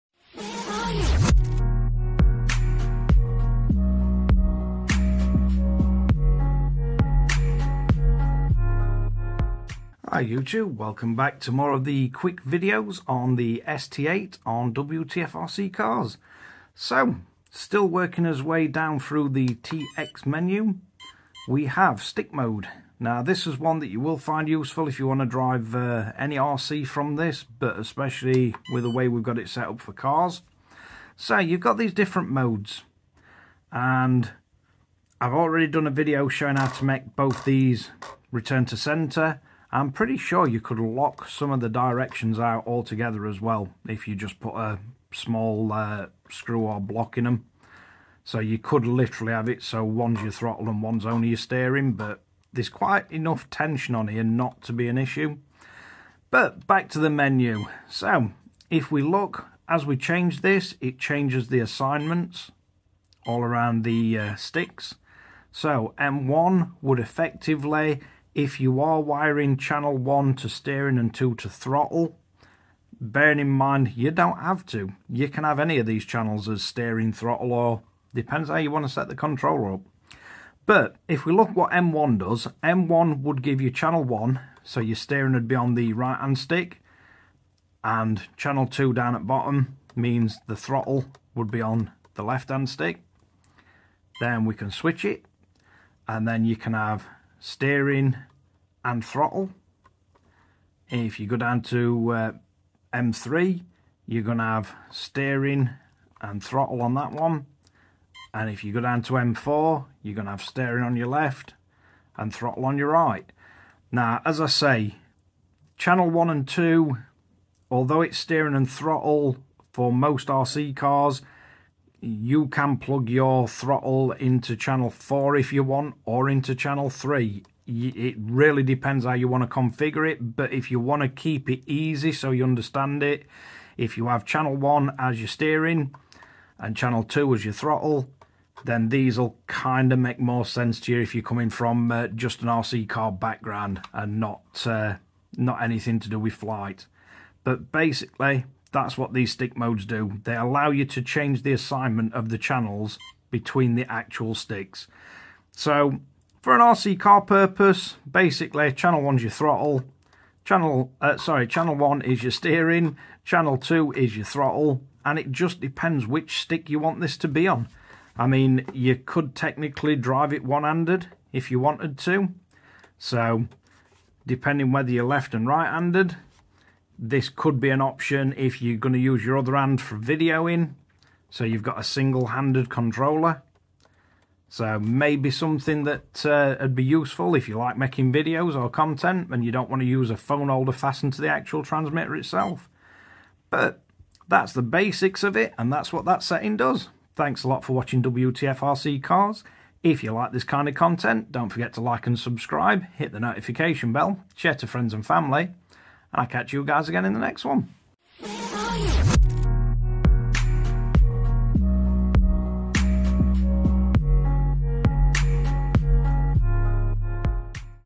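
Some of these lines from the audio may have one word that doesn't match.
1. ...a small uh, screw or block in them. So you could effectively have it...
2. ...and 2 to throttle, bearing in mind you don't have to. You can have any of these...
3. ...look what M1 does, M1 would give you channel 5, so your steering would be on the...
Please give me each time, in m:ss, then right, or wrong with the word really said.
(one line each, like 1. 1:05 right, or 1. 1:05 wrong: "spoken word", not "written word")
1. 0:44 wrong: "literally", not "effectively"
2. 1:10 right
3. 1:21 wrong: "1", not "5".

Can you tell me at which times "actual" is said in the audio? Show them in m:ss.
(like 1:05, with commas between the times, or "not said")
2:33, 3:11.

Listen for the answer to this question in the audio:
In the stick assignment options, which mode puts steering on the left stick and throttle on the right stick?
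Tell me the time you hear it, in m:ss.
1:49.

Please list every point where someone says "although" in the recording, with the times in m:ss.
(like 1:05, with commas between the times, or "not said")
1:57.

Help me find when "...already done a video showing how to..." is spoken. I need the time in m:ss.
0:35.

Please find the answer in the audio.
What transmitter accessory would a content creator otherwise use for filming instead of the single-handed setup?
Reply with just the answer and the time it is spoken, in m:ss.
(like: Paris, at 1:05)
Phone holder, at 3:10.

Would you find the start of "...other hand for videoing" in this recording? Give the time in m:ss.
2:59.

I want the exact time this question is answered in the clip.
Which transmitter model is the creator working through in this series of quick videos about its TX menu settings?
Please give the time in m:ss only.
0:13.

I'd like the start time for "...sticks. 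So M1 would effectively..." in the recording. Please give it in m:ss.
1:04.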